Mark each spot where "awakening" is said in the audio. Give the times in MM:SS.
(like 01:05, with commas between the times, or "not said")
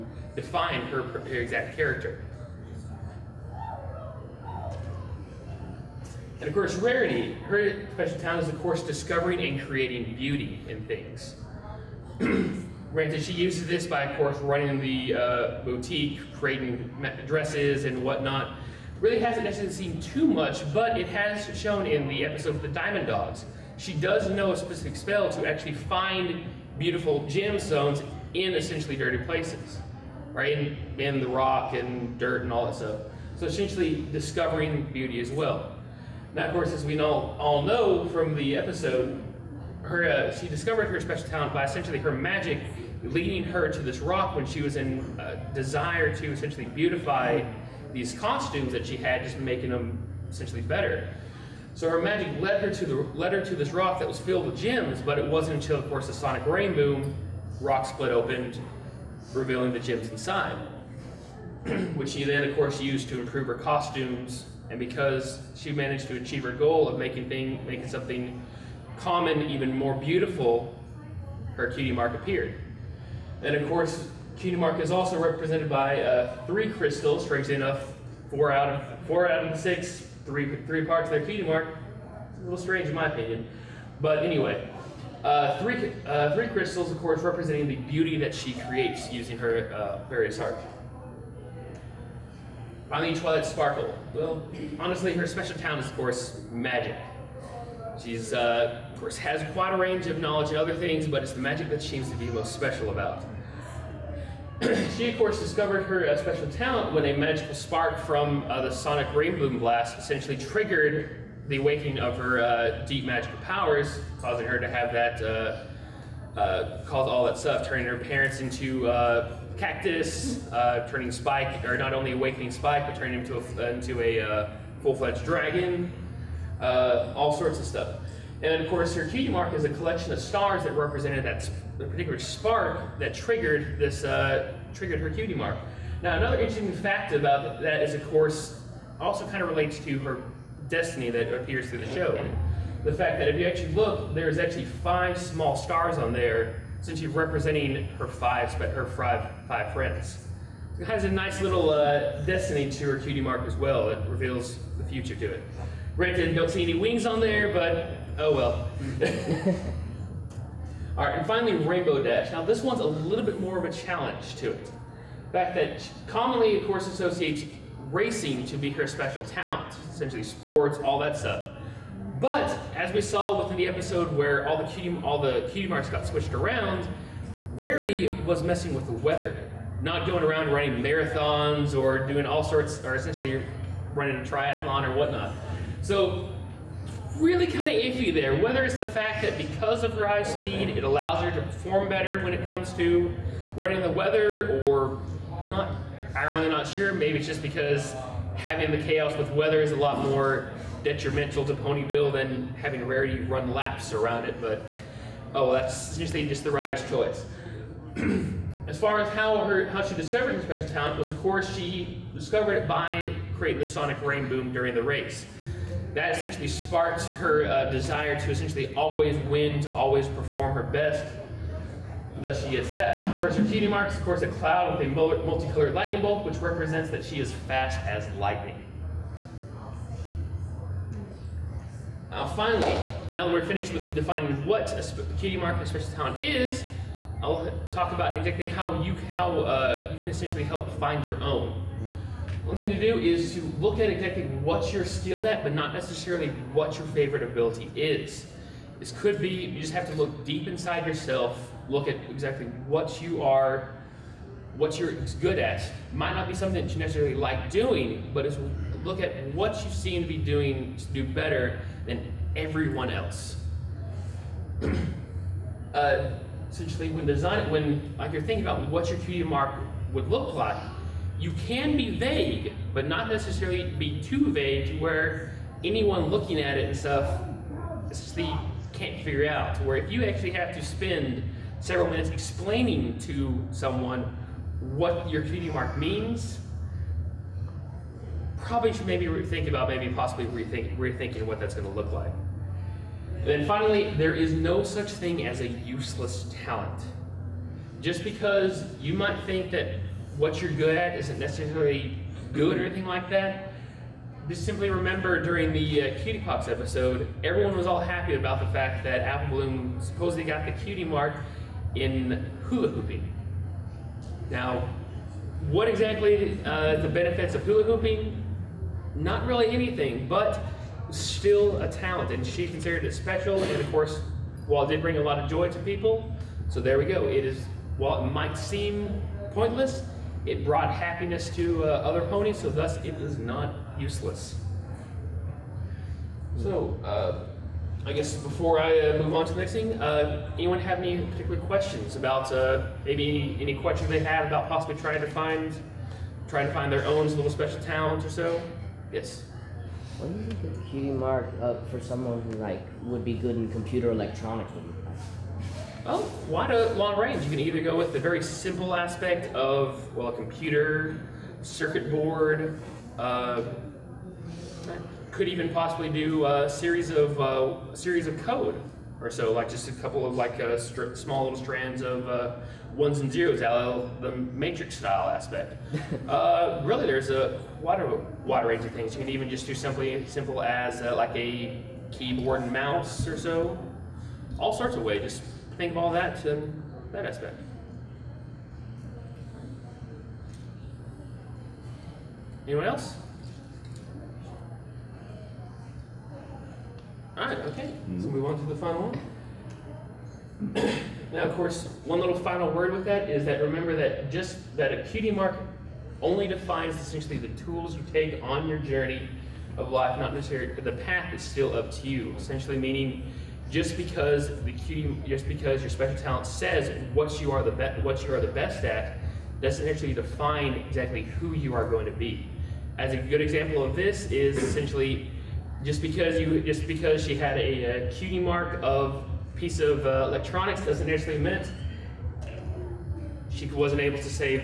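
01:51, 02:02.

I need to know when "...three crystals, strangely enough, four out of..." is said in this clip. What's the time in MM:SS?
01:16.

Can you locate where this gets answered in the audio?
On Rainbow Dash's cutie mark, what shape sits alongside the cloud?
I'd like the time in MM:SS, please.
03:44.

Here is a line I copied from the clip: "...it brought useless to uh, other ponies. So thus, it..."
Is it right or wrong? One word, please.
wrong.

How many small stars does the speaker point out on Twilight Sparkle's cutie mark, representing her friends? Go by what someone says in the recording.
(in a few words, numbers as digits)
5.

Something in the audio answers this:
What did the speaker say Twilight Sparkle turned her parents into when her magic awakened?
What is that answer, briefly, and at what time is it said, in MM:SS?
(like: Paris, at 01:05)
Cactus, at 01:59.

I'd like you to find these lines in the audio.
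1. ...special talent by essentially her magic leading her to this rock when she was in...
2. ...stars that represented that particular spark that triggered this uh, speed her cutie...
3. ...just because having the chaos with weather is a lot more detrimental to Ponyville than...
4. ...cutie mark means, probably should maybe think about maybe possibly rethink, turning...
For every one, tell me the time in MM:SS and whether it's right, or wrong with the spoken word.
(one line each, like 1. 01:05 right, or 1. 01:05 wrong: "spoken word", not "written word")
1. 00:40 right
2. 02:10 wrong: "triggered", not "speed"
3. 03:17 right
4. 04:45 wrong: "rethinking", not "turning".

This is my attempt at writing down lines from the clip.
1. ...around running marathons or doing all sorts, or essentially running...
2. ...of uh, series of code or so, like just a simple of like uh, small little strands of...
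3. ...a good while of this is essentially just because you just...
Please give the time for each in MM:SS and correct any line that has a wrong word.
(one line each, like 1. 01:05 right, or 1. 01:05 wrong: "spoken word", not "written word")
1. 03:00 right
2. 06:06 wrong: "couple", not "simple"
3. 07:02 wrong: "example", not "while".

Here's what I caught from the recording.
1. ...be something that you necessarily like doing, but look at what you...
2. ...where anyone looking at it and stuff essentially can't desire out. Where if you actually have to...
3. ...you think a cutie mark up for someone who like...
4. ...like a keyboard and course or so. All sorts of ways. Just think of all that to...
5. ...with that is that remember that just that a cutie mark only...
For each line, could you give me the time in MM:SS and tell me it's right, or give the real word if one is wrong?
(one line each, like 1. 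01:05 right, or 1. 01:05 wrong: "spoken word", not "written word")
1. 04:16 right
2. 04:34 wrong: "figure", not "desire"
3. 05:50 right
4. 06:20 wrong: "mouse", not "course"
5. 06:42 right.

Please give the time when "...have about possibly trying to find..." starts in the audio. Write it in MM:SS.
05:43.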